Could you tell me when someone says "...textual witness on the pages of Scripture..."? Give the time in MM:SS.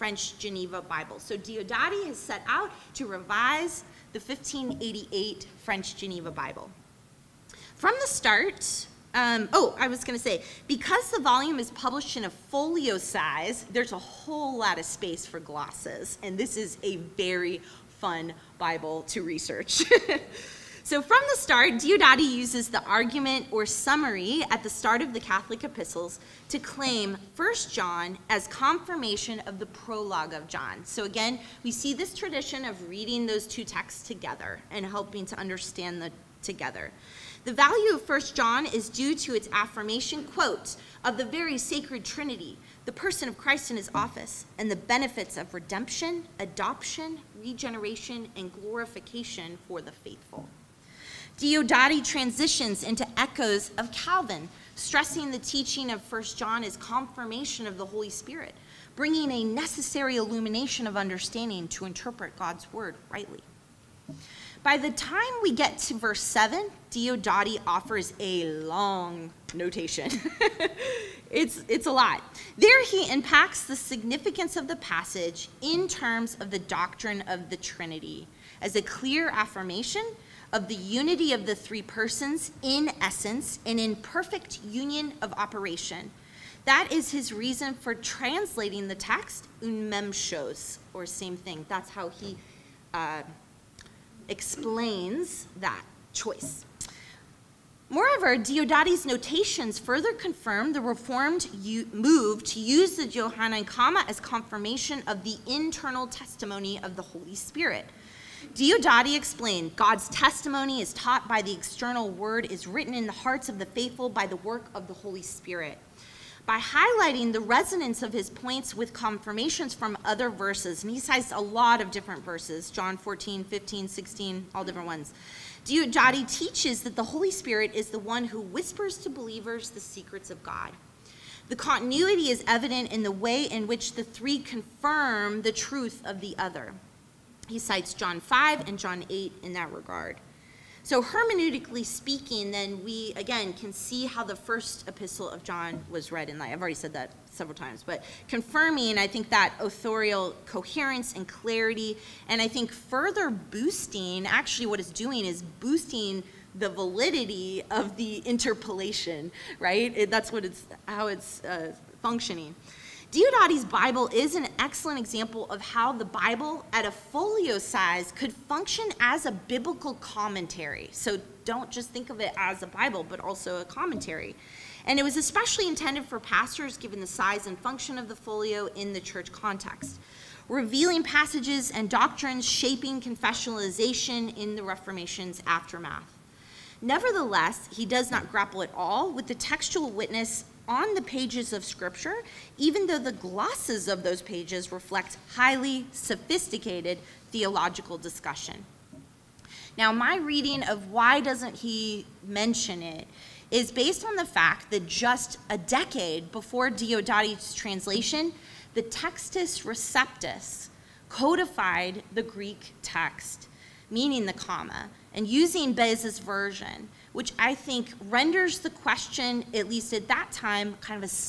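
03:09.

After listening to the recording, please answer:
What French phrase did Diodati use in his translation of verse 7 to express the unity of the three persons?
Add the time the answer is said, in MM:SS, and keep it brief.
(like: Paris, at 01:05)
une même chose, at 01:29.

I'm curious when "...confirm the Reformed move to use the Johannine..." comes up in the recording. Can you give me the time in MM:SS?
01:40.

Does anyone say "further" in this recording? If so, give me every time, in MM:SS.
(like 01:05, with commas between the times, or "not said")
01:39, 02:32.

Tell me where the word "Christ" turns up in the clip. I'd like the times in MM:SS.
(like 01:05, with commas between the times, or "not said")
00:43.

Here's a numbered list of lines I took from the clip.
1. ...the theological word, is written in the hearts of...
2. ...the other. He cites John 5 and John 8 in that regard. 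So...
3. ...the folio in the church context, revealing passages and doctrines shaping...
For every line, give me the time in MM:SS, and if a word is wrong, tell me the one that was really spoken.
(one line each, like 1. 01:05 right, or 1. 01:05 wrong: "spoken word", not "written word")
1. 01:51 wrong: "external", not "theological"
2. 02:16 right
3. 02:58 right.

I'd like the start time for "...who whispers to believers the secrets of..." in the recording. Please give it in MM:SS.
02:08.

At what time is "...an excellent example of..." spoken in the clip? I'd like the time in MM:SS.
02:44.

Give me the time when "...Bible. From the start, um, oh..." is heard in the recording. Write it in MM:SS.
00:06.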